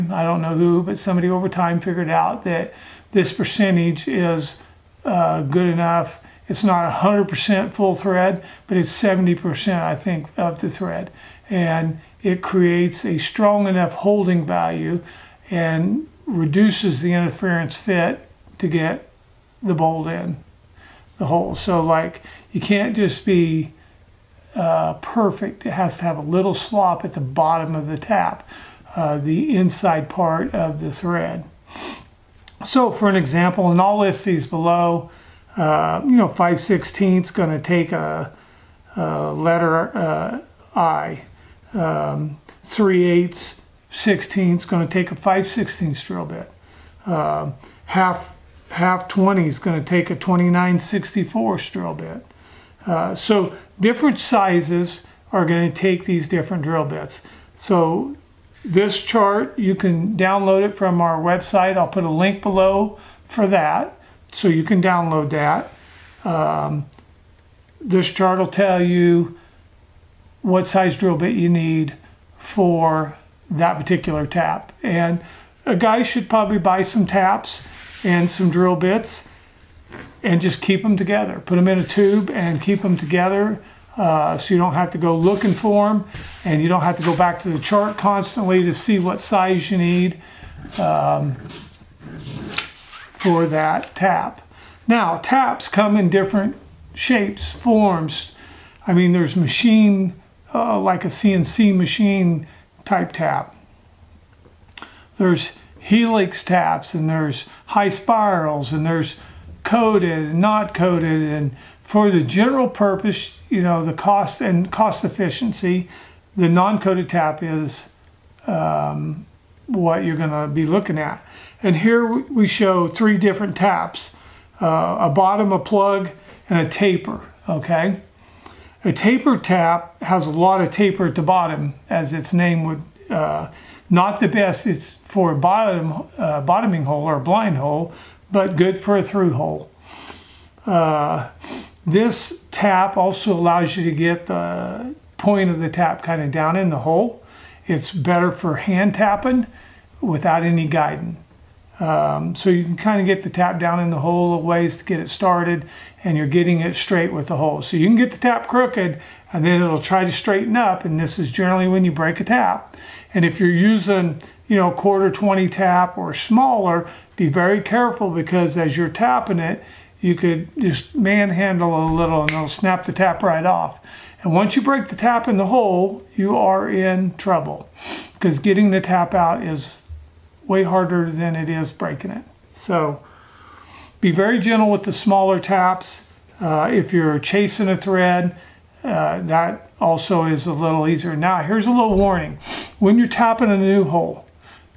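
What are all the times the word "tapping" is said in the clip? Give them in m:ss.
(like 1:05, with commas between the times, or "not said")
2:28, 2:48, 3:13.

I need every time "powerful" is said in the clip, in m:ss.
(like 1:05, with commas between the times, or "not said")
not said.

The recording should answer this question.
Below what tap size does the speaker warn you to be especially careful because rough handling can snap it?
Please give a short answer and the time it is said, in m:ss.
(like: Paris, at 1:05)
1/4-20, at 2:44.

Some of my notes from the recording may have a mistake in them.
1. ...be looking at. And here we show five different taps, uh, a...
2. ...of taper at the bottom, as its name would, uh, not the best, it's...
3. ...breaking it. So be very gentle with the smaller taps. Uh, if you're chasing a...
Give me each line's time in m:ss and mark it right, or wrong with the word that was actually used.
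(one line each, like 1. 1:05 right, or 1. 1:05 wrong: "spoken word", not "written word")
1. 2:00 wrong: "three", not "five"
2. 2:10 right
3. 3:01 right.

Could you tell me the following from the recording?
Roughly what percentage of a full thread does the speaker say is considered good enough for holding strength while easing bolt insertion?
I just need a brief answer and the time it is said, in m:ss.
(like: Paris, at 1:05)
70%, at 0:08.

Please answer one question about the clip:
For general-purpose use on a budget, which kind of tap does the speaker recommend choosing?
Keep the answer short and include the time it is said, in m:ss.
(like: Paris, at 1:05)
Non-coated tap, at 1:56.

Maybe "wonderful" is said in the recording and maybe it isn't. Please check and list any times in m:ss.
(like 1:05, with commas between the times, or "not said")
not said.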